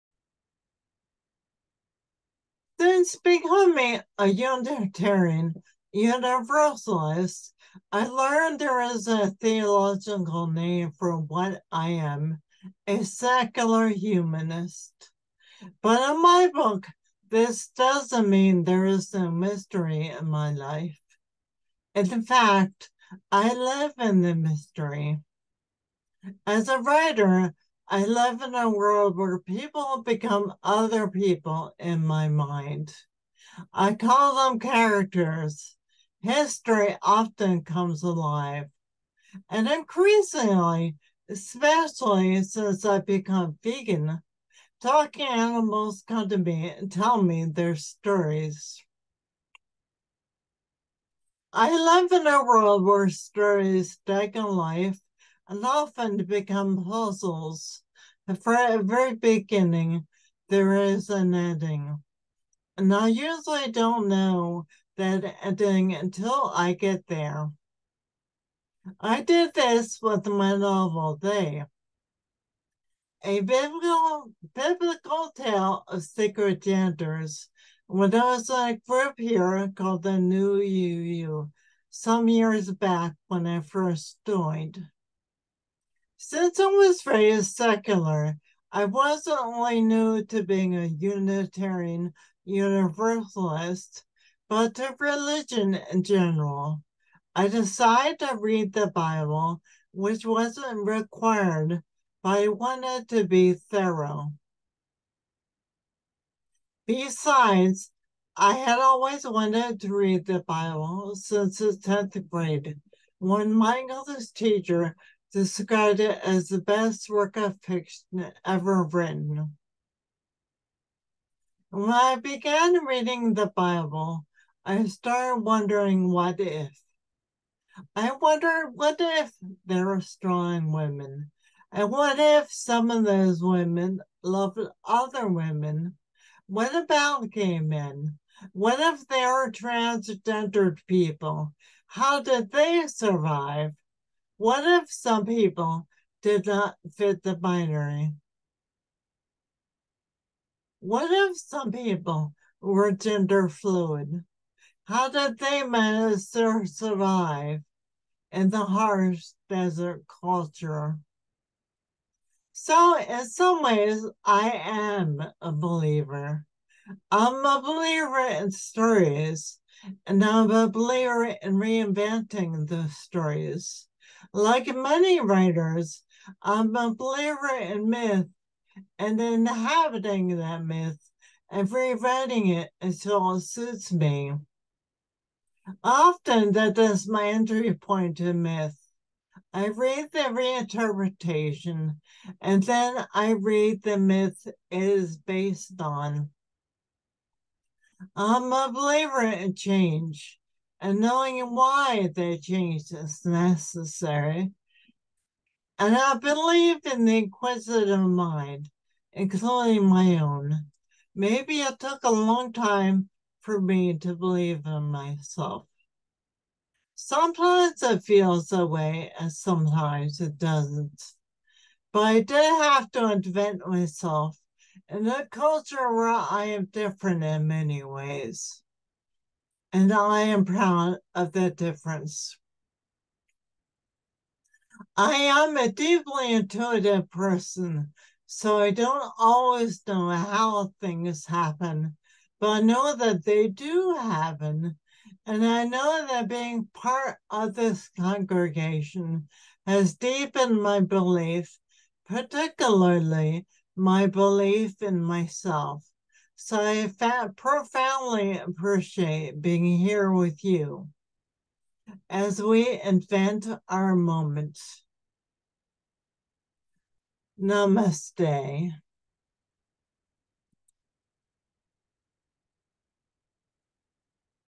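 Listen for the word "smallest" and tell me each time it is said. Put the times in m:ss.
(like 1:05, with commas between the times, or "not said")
not said.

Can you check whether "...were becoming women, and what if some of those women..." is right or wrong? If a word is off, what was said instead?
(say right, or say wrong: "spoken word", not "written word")
wrong: "strong", not "becoming".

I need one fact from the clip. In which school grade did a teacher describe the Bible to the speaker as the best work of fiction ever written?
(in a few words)
10th grade.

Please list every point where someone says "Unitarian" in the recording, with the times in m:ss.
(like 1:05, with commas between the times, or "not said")
0:04, 1:30.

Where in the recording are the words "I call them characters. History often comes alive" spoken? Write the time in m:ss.
0:33.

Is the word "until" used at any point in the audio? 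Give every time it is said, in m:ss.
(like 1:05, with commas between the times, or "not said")
1:05, 3:02.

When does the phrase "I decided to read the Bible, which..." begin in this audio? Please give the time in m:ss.
1:37.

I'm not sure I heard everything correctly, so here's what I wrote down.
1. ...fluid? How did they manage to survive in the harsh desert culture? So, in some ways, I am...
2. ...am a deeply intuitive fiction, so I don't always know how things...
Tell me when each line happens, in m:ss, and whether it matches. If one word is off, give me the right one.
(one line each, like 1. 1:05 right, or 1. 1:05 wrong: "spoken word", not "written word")
1. 2:33 right
2. 3:55 wrong: "person", not "fiction".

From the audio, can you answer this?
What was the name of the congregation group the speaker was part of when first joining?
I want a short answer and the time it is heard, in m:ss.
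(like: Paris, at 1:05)
New UU, at 1:20.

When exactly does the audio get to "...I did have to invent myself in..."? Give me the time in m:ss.
3:41.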